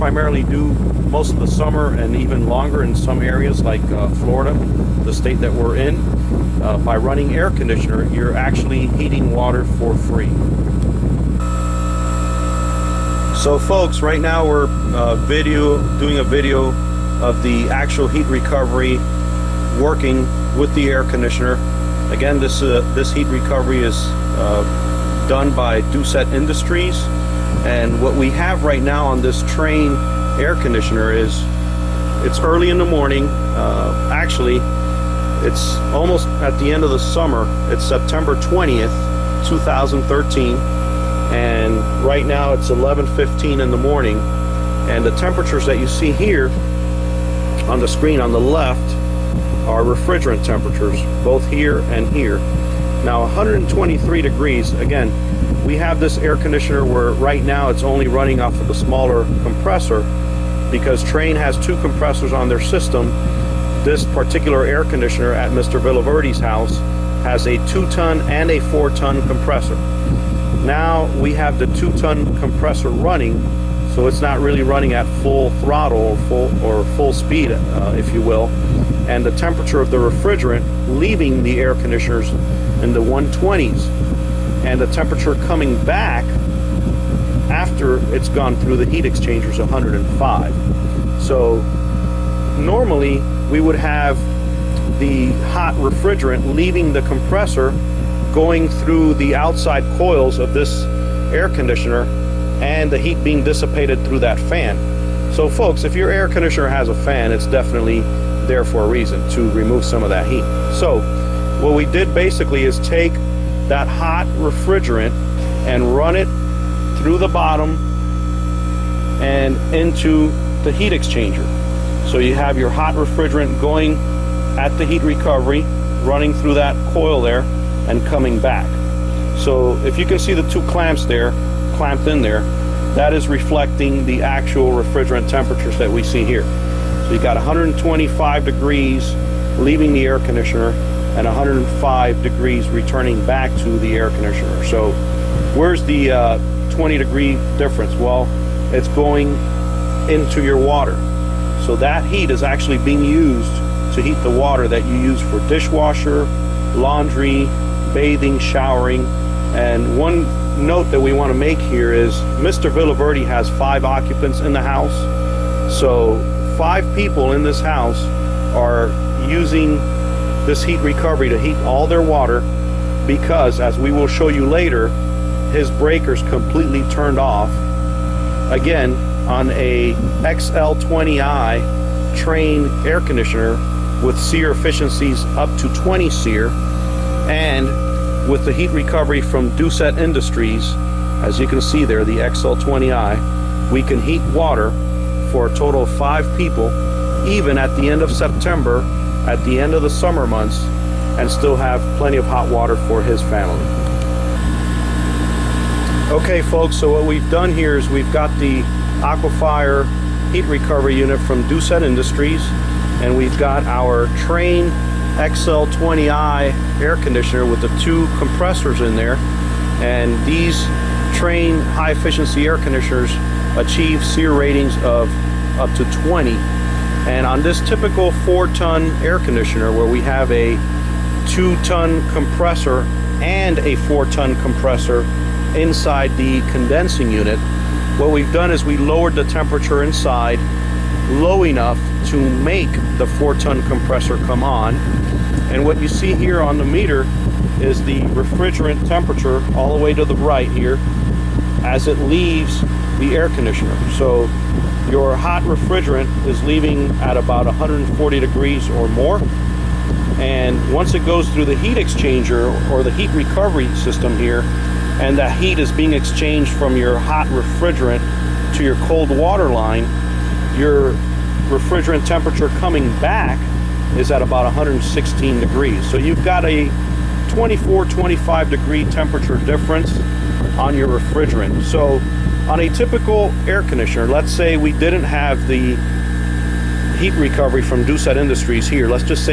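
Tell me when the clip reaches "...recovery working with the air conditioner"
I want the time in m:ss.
0:18.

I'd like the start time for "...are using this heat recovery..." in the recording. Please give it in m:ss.
2:48.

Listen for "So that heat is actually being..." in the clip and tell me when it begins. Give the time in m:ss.
2:31.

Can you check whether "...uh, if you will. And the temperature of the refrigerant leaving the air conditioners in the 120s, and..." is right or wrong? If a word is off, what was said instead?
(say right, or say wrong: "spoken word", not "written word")
right.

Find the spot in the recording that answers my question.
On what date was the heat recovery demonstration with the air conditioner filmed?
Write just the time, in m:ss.
0:37.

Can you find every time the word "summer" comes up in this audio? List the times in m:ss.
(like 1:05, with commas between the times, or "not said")
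0:01, 0:36, 3:19.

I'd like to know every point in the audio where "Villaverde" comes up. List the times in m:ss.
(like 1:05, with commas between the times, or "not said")
1:05, 2:42.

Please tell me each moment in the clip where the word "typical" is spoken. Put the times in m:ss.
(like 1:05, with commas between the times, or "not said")
3:47, 4:42.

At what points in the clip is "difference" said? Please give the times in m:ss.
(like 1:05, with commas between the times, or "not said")
2:27, 4:39.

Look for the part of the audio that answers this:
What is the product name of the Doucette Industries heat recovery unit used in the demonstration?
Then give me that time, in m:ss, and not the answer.
3:29.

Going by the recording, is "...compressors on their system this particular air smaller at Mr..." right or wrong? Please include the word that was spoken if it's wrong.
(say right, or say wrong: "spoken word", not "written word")
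wrong: "conditioner", not "smaller".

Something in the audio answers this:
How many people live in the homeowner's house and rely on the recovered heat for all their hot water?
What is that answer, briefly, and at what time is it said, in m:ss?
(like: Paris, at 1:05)
5, at 2:43.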